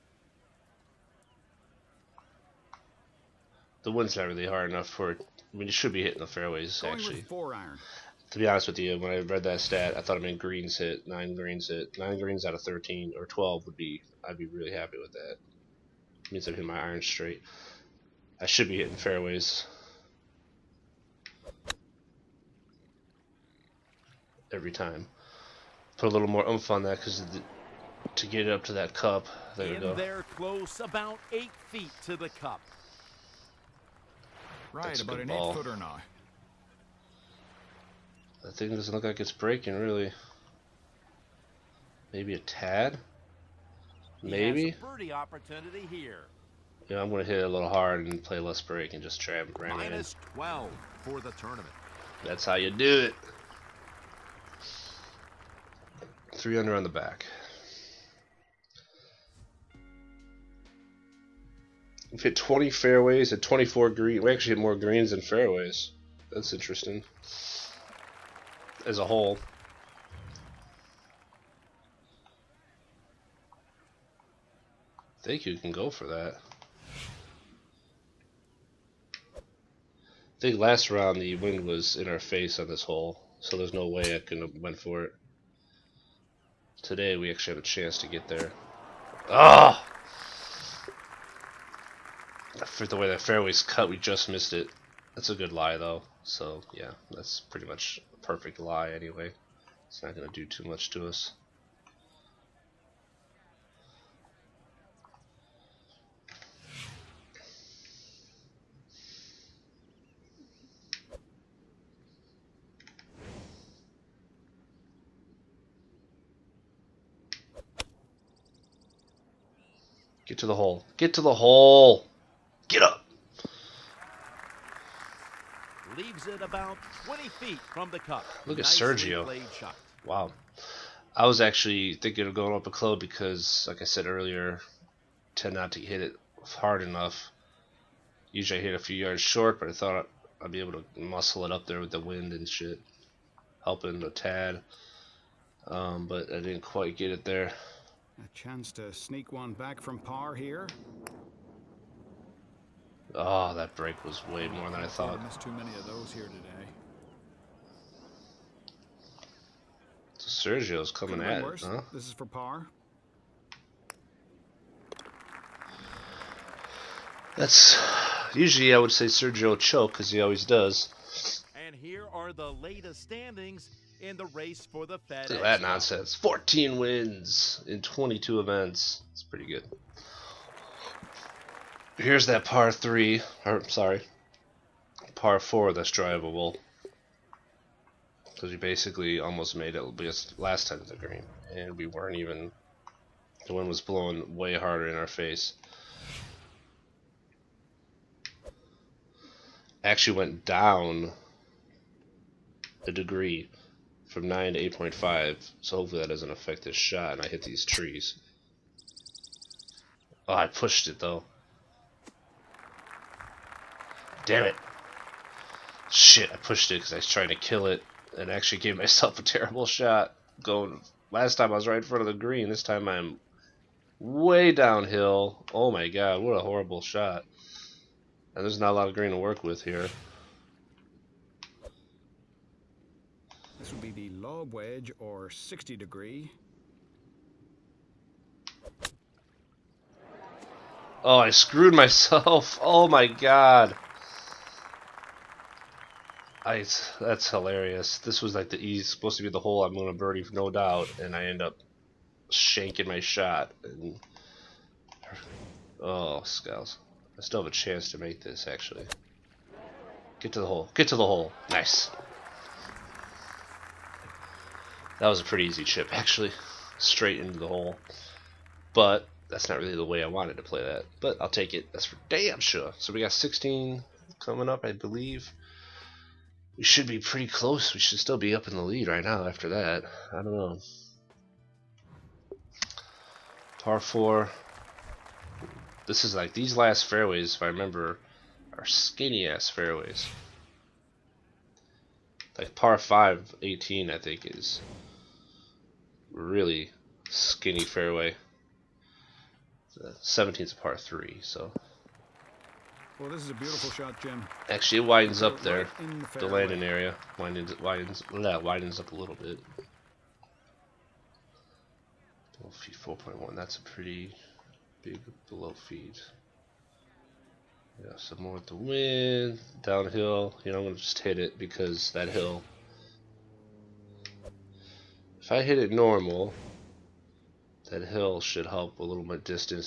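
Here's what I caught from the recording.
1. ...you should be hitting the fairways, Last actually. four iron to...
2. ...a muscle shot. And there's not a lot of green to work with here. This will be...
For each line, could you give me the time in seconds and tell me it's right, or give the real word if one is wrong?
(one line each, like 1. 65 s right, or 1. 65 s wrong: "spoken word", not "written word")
1. 5 s wrong: "Going", not "Last"
2. 226 s wrong: "horrible", not "muscle".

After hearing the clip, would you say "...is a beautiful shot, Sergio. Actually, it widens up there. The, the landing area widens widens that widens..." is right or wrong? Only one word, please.
wrong.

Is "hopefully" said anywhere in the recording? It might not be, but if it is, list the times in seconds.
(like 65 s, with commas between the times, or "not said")
205 s.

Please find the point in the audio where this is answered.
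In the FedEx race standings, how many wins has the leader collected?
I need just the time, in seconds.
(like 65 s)
176 s.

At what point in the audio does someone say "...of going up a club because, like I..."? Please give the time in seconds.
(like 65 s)
132 s.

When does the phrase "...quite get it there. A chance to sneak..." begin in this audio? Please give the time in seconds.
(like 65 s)
146 s.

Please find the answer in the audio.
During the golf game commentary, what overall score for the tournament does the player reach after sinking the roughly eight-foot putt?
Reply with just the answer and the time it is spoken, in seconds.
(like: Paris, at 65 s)
-12, at 49 s.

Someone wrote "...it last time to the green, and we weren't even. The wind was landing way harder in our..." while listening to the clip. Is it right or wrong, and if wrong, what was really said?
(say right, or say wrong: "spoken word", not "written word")
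wrong: "blowing", not "landing".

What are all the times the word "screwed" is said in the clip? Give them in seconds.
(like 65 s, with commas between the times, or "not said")
241 s.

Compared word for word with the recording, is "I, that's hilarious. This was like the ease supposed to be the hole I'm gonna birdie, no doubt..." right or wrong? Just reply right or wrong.
right.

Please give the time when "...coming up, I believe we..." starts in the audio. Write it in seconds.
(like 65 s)
274 s.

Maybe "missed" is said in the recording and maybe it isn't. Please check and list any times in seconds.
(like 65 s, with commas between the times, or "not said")
94 s, 155 s.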